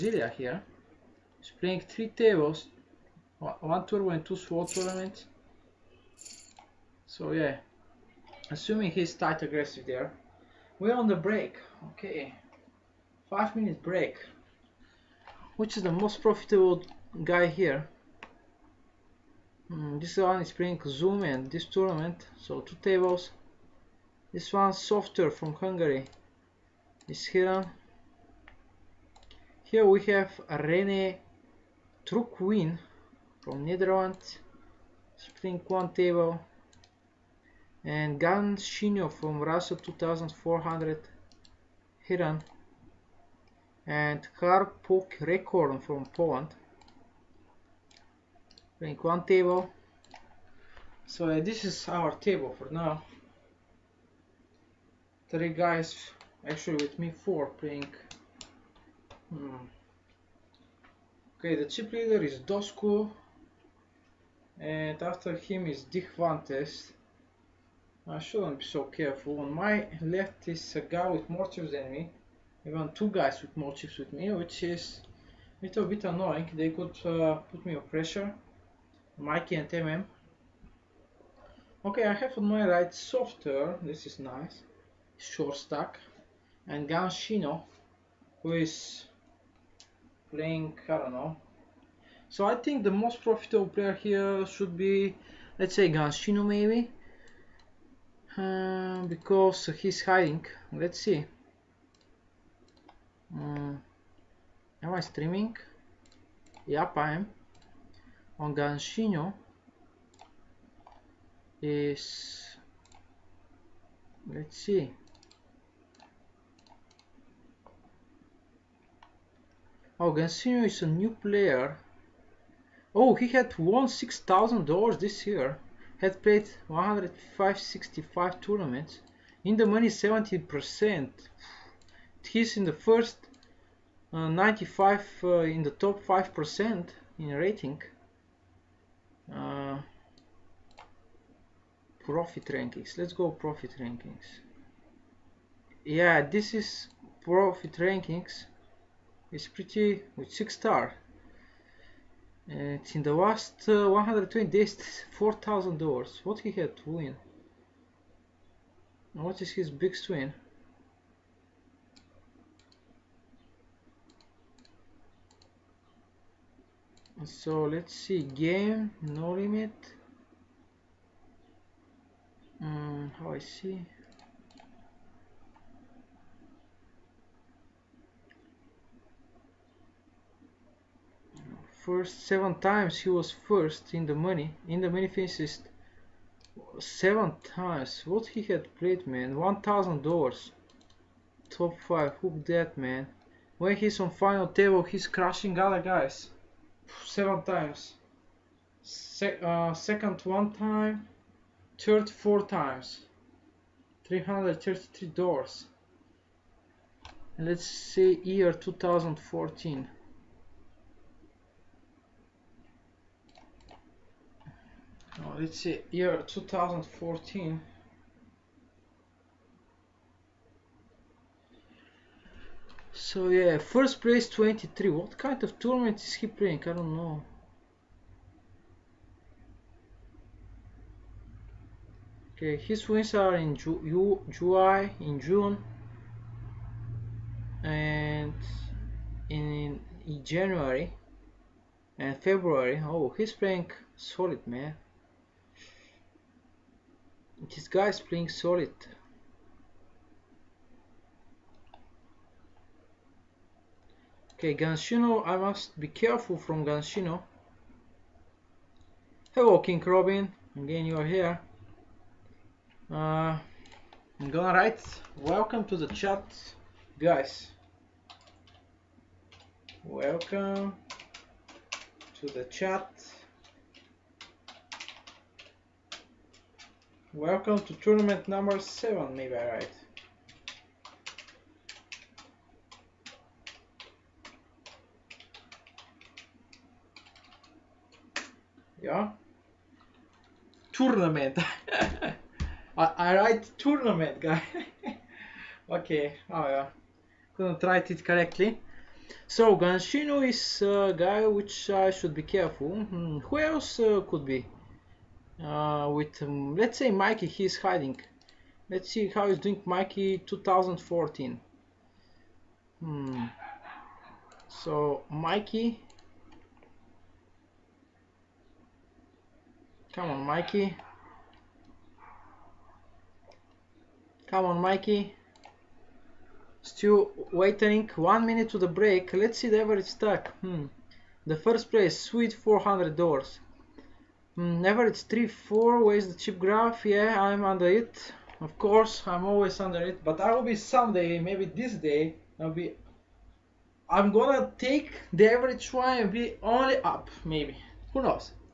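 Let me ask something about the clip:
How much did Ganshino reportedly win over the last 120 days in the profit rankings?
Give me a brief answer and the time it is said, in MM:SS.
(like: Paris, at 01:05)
$4,000, at 02:35.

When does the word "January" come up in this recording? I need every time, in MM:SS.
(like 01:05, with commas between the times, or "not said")
04:00.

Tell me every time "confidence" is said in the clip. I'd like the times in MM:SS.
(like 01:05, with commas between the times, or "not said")
not said.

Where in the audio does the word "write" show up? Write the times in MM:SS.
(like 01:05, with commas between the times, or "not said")
04:24, 04:53, 04:57.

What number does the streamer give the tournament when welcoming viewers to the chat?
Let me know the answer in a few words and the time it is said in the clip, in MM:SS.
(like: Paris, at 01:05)
7, at 04:38.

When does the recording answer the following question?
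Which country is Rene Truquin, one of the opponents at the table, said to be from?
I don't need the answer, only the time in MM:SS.
00:33.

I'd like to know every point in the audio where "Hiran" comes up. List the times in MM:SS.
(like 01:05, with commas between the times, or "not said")
00:27.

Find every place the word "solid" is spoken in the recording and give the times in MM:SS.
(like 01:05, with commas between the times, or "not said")
04:03, 04:08.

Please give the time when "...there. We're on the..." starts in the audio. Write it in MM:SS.
00:09.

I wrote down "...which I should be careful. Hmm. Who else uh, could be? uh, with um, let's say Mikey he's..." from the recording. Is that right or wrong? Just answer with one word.
right.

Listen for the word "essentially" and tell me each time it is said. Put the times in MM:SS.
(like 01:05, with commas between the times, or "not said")
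not said.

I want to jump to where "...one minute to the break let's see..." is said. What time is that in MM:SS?
05:27.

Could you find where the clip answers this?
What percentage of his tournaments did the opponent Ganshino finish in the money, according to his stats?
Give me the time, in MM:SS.
02:09.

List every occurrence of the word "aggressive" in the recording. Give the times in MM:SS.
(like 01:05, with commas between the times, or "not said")
00:09.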